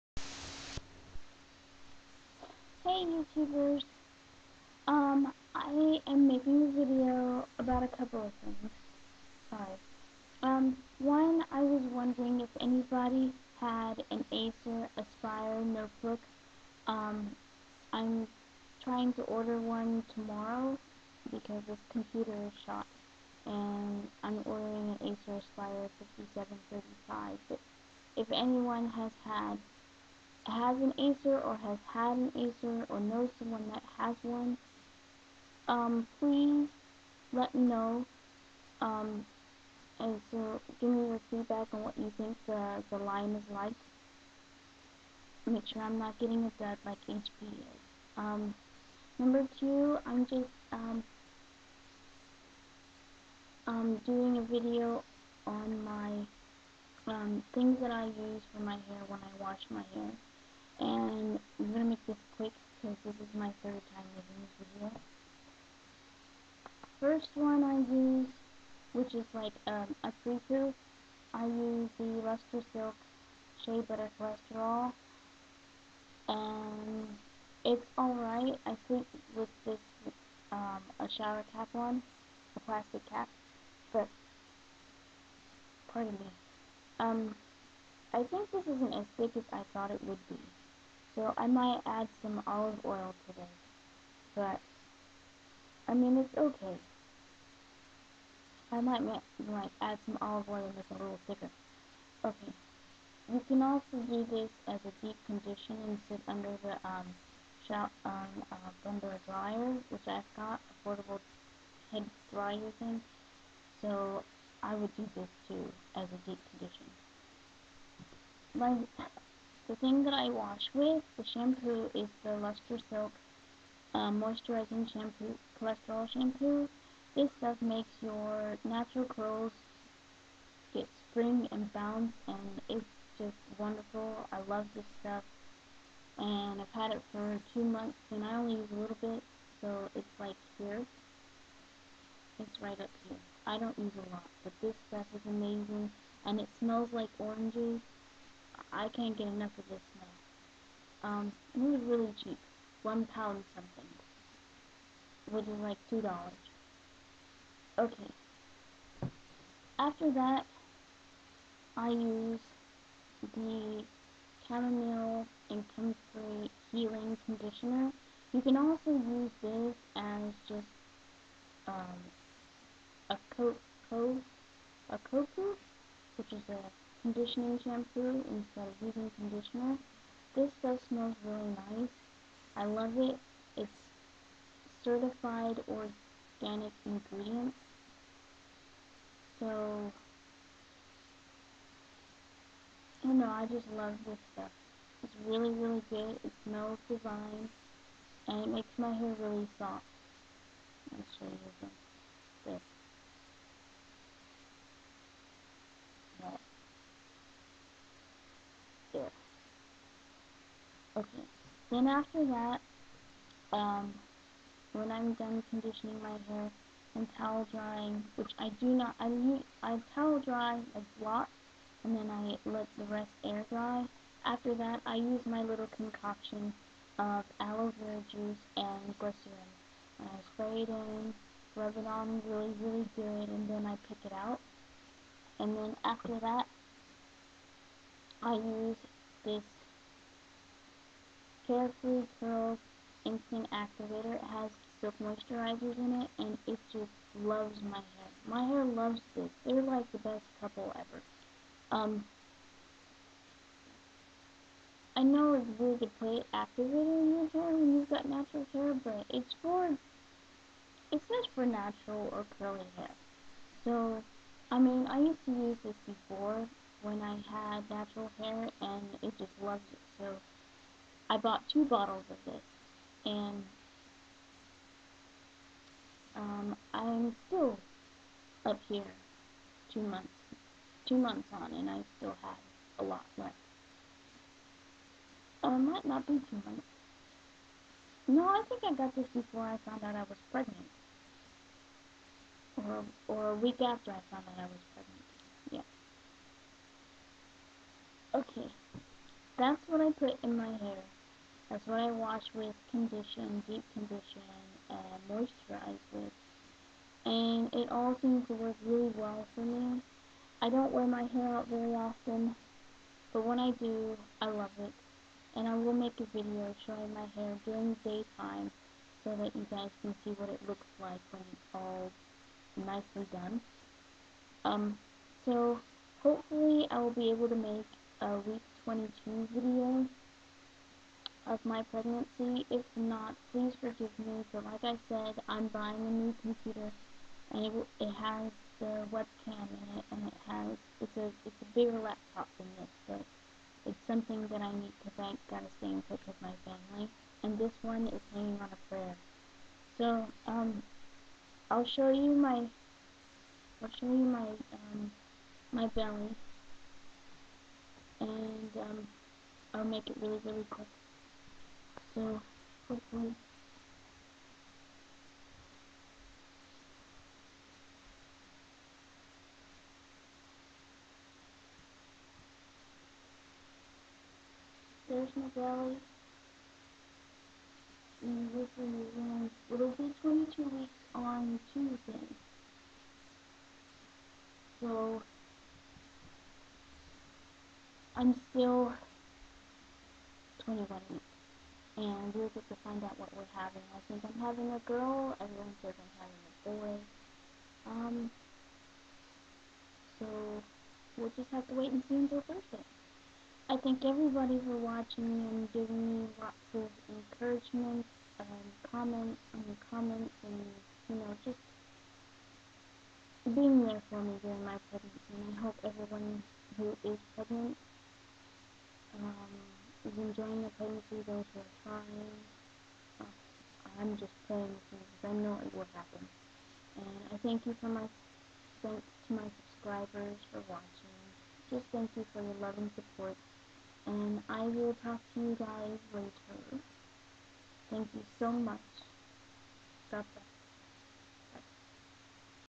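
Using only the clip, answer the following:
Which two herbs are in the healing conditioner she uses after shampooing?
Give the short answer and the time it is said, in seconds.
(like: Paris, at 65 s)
chamomile and comfrey, at 164 s.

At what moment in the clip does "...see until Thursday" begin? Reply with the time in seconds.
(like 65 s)
401 s.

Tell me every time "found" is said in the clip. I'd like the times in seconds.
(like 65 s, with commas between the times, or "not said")
289 s, 294 s.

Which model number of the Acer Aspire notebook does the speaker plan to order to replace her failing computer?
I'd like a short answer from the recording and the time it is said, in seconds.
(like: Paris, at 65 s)
5735, at 25 s.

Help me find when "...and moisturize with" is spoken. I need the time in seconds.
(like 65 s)
304 s.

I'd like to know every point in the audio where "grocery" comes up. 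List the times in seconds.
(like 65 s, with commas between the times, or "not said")
not said.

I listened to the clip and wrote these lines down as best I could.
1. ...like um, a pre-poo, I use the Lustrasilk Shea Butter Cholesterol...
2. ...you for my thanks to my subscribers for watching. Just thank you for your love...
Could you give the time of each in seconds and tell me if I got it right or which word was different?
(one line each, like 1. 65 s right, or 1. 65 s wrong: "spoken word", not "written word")
1. 69 s right
2. 427 s right.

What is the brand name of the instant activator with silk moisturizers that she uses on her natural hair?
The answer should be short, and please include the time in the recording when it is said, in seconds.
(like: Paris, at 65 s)
Carefree Curl, at 241 s.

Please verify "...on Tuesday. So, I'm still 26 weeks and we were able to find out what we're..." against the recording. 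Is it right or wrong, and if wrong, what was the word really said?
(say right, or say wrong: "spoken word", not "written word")
wrong: "21", not "26".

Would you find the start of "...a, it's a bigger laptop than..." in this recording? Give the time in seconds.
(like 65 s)
340 s.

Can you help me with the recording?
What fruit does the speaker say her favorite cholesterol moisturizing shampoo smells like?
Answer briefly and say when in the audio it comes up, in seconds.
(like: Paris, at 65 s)
oranges, at 147 s.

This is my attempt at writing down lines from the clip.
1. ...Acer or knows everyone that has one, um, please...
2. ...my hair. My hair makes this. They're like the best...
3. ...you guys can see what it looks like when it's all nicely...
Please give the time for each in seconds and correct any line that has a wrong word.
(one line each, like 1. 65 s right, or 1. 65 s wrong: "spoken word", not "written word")
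1. 32 s wrong: "someone", not "everyone"
2. 247 s wrong: "loves", not "makes"
3. 319 s right.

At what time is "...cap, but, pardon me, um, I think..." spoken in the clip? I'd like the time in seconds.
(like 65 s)
83 s.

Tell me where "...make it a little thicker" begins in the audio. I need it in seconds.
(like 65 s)
100 s.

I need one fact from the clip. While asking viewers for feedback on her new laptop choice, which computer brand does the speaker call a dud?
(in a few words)
HP.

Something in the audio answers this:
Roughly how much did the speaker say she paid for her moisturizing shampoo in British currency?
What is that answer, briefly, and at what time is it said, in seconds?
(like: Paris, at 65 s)
One pound something, at 152 s.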